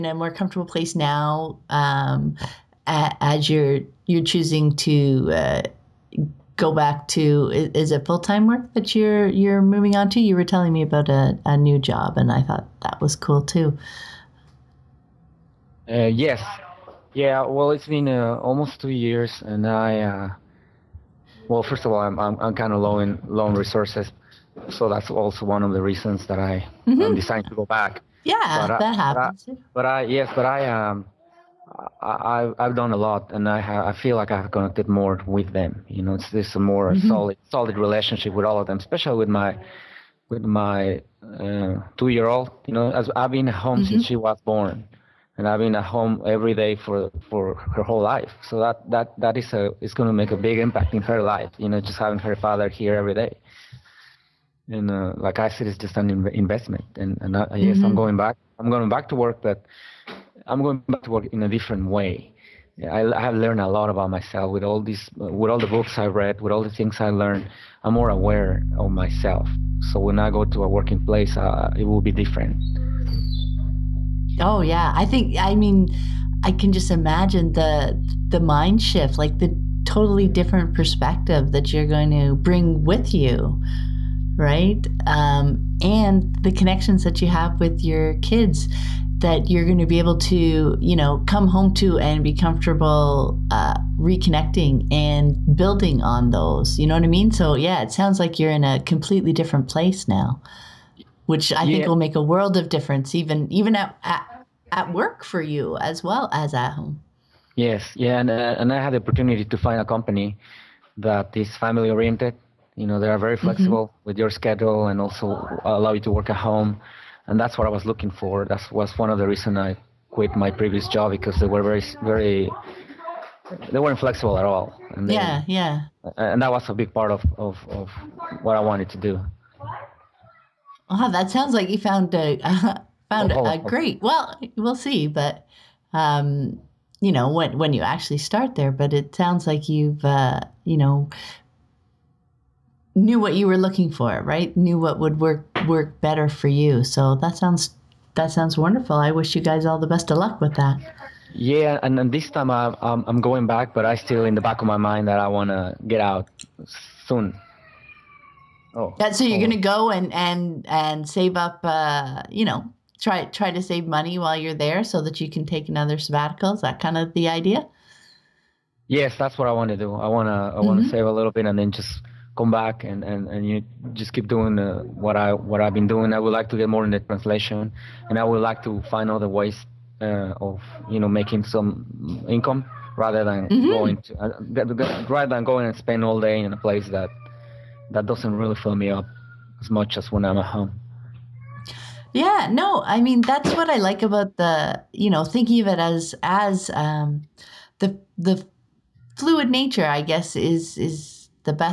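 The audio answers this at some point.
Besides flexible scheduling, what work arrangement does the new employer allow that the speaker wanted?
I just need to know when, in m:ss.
1:56.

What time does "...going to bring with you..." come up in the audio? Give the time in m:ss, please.
1:21.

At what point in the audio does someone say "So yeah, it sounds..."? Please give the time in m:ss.
1:37.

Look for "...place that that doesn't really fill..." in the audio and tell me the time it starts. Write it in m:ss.
3:06.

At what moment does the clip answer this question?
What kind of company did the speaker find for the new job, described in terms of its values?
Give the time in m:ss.
1:51.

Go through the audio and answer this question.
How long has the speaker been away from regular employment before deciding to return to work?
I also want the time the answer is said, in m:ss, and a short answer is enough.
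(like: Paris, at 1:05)
almost 2 years, at 0:18.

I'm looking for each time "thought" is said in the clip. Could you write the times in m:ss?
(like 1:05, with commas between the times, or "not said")
0:12.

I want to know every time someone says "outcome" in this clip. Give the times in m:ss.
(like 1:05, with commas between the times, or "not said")
not said.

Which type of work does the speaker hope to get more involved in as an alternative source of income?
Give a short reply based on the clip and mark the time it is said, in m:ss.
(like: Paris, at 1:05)
translation, at 2:56.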